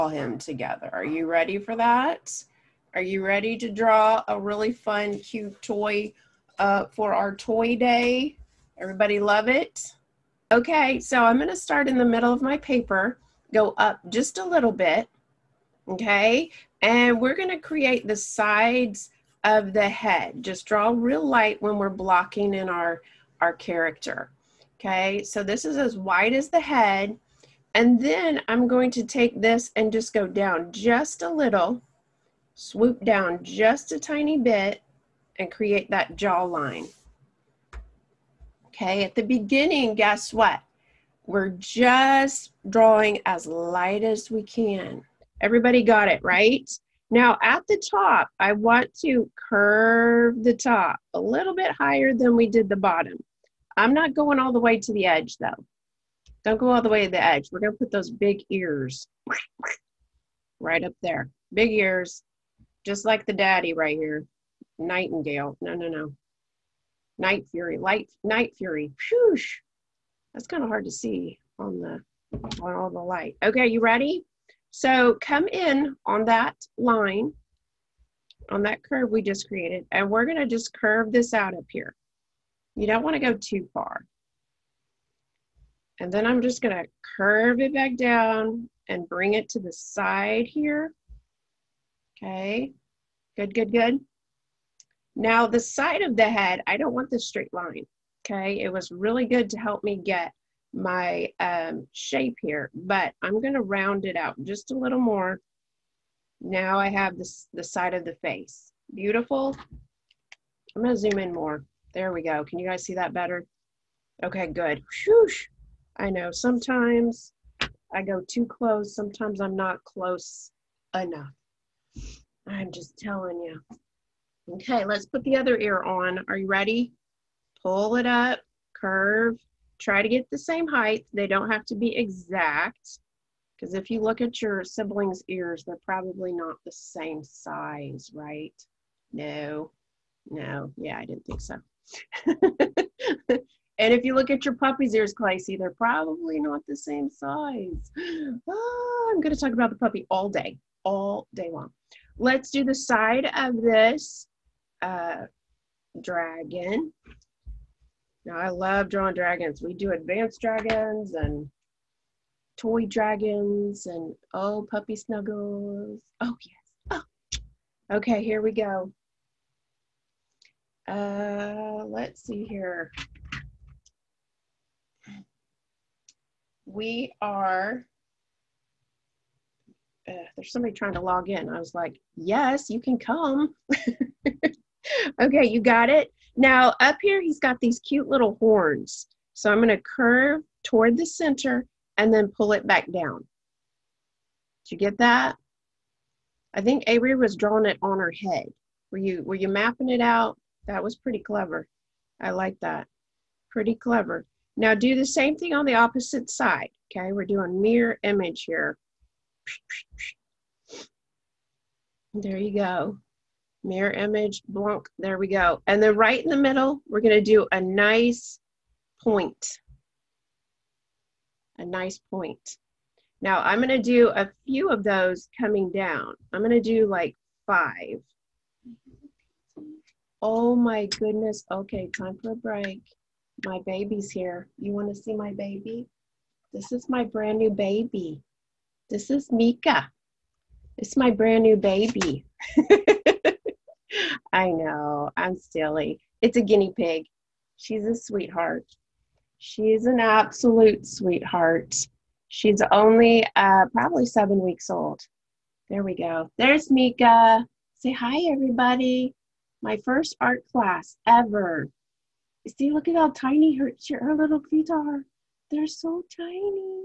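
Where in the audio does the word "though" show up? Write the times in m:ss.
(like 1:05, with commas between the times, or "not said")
0:55.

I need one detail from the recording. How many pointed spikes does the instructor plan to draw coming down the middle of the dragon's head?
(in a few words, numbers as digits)
5.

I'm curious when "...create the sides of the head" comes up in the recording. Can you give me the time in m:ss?
0:17.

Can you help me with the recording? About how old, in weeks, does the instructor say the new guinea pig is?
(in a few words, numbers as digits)
7 weeks.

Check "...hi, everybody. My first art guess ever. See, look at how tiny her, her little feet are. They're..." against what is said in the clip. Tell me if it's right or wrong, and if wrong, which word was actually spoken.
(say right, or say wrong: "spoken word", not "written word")
wrong: "class", not "guess".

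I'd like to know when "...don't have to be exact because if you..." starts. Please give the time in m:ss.
2:11.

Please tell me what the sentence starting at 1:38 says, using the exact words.
It was really good to help me get my um, shape here, but I'm gonna round it out just a little more.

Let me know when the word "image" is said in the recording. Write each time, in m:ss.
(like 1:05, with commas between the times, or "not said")
3:28, 3:33.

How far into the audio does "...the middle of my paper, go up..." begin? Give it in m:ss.
0:11.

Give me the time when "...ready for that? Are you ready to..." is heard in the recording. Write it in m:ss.
0:01.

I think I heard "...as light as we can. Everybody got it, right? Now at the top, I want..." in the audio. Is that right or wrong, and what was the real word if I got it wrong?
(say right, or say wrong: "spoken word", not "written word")
right.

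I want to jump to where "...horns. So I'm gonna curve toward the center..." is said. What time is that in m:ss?
3:08.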